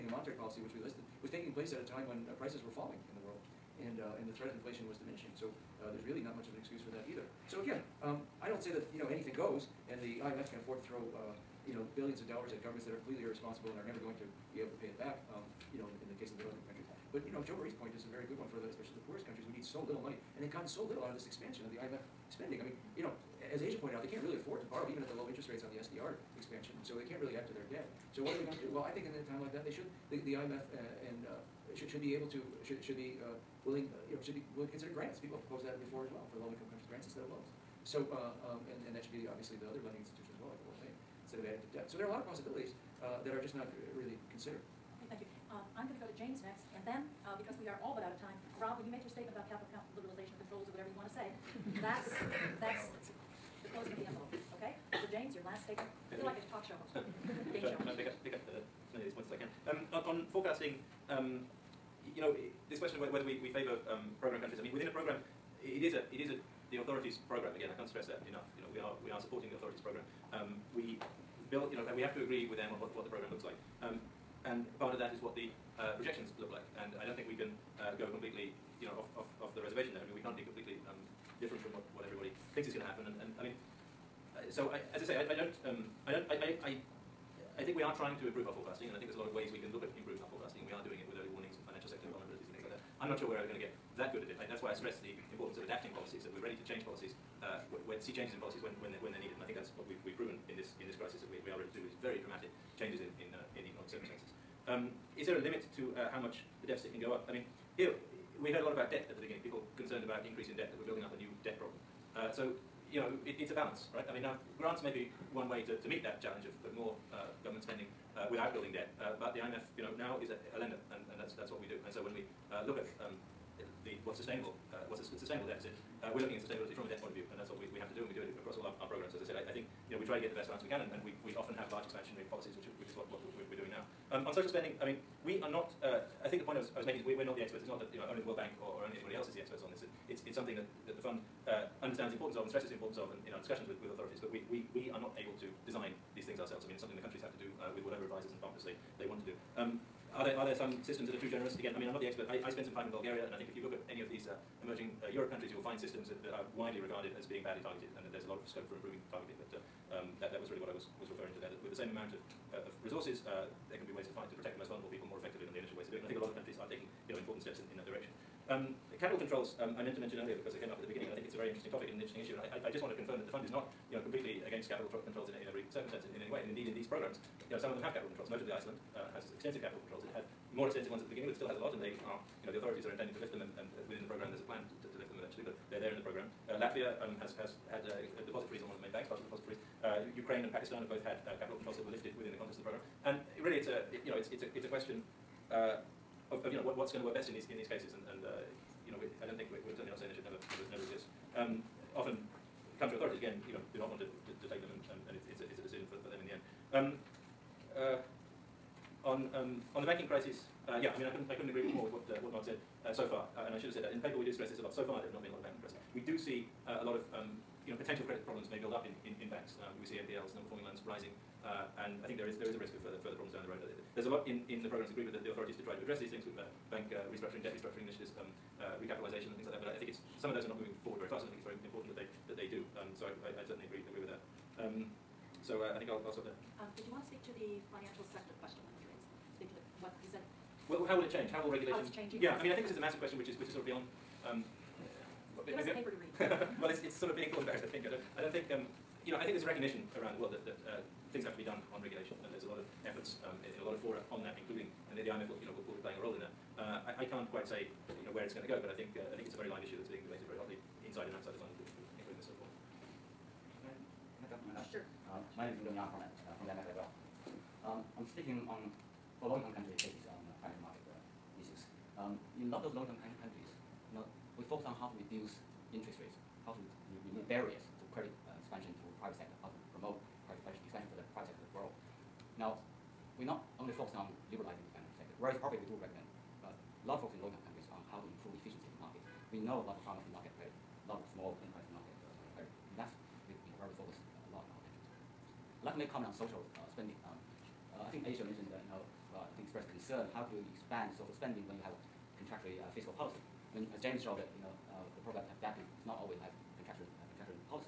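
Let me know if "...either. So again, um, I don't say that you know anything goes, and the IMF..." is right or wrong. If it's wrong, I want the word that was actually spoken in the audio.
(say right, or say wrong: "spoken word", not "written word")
right.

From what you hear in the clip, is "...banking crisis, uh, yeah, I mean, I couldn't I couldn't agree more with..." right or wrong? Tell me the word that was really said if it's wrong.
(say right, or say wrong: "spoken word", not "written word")
right.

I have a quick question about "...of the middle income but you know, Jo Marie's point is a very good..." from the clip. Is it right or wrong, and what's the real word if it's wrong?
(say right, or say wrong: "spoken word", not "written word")
right.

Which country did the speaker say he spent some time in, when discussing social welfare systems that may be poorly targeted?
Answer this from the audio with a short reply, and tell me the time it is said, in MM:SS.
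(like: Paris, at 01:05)
Bulgaria, at 02:32.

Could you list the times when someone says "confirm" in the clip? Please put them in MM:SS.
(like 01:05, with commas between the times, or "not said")
02:52.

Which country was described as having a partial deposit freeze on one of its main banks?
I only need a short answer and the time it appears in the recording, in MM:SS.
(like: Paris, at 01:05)
Latvia, at 03:06.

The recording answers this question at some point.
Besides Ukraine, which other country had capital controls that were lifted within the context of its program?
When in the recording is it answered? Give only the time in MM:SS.
03:10.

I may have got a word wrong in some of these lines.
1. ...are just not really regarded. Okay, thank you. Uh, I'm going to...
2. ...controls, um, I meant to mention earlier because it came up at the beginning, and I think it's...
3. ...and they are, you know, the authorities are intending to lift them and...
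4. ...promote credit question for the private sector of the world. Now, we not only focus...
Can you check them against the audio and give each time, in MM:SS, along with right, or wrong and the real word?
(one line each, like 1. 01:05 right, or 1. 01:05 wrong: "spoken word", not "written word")
1. 00:43 wrong: "considered", not "regarded"
2. 02:49 right
3. 03:01 right
4. 04:39 wrong: "expansion", not "question".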